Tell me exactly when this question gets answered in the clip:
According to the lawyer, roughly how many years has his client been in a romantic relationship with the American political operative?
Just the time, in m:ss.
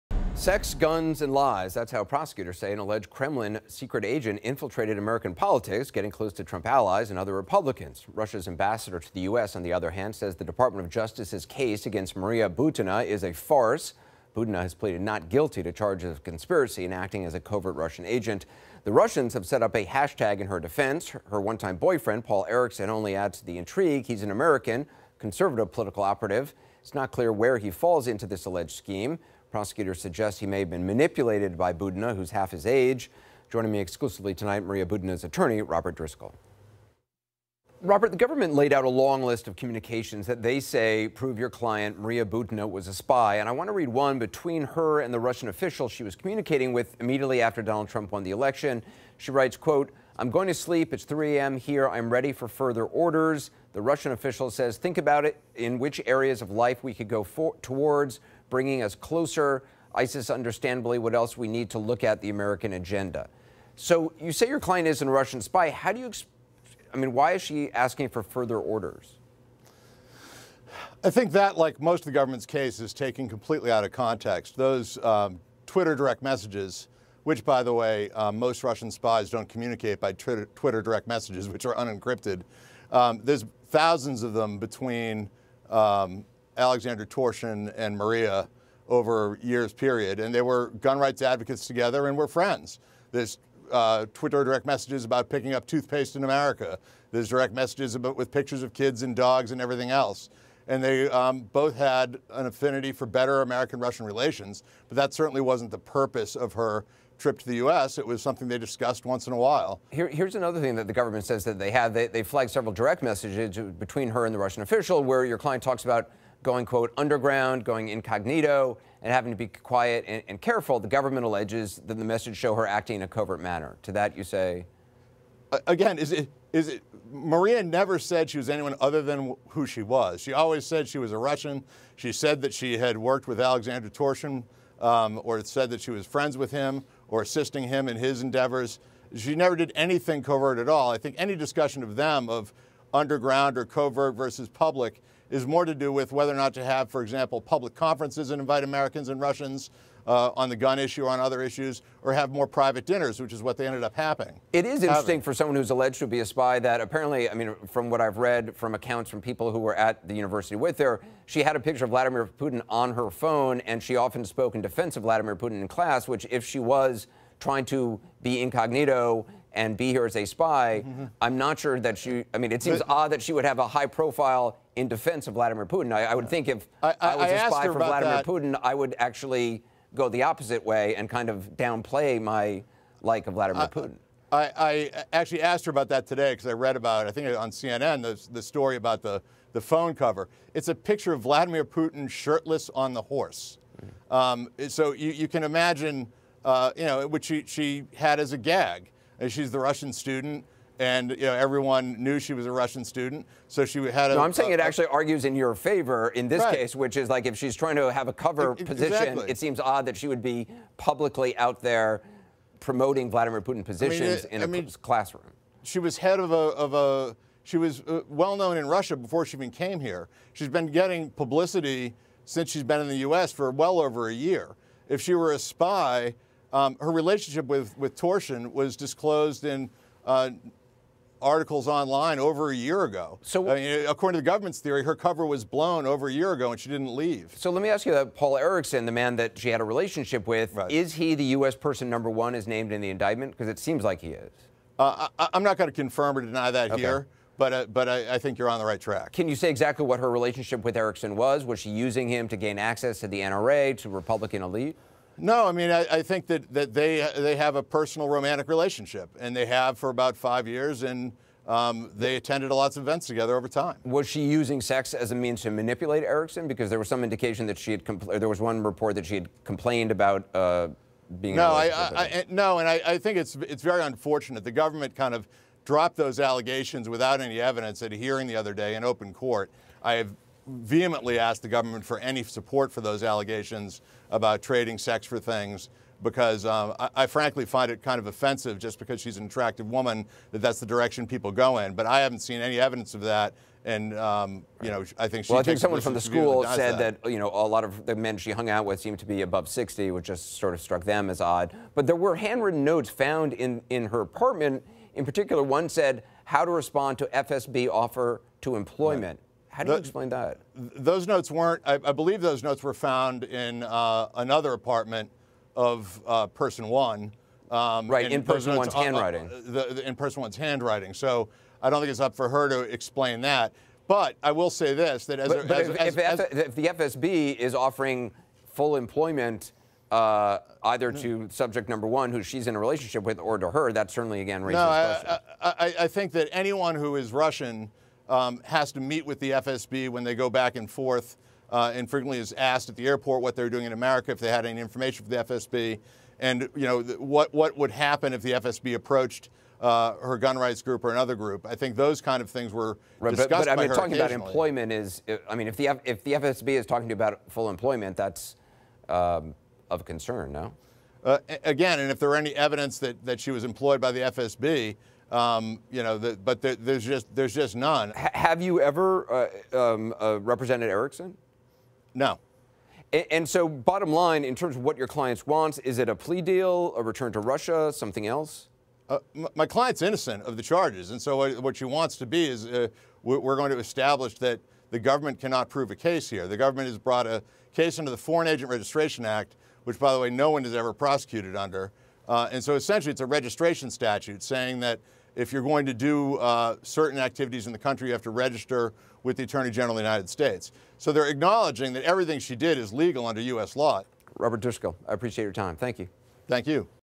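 4:20.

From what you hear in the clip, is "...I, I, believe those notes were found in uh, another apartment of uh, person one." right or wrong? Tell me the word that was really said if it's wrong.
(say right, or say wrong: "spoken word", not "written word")
right.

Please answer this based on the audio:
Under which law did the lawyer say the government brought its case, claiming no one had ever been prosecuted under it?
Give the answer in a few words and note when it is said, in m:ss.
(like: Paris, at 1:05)
Foreign Agent Registration Act, at 6:27.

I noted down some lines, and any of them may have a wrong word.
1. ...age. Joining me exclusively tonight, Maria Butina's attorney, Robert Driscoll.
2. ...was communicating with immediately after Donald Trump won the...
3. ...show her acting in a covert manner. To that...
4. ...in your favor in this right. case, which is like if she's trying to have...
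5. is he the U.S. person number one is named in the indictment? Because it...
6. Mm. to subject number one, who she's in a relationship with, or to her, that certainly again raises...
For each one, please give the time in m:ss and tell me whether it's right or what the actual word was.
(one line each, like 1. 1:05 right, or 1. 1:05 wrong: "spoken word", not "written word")
1. 0:32 right
2. 0:46 right
3. 2:02 right
4. 3:25 right
5. 4:00 right
6. 5:30 right.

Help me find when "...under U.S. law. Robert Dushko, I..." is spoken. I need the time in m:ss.
6:43.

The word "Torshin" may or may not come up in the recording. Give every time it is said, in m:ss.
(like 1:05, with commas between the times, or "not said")
1:27, 2:13, 3:47.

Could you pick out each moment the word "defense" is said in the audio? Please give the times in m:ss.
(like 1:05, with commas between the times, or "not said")
0:20, 2:44, 2:54.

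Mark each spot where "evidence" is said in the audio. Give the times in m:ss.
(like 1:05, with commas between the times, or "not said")
4:37, 4:52, 6:02.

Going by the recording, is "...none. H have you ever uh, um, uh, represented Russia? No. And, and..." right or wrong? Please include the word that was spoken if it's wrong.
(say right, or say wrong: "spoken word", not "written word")
wrong: "Erickson", not "Russia".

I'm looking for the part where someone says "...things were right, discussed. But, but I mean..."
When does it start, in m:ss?
5:52.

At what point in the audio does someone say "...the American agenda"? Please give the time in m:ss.
1:02.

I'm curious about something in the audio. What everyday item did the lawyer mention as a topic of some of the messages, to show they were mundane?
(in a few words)
toothpaste.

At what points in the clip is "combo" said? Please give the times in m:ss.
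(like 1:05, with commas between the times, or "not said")
not said.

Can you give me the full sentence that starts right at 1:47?
It was something they discussed once in a while.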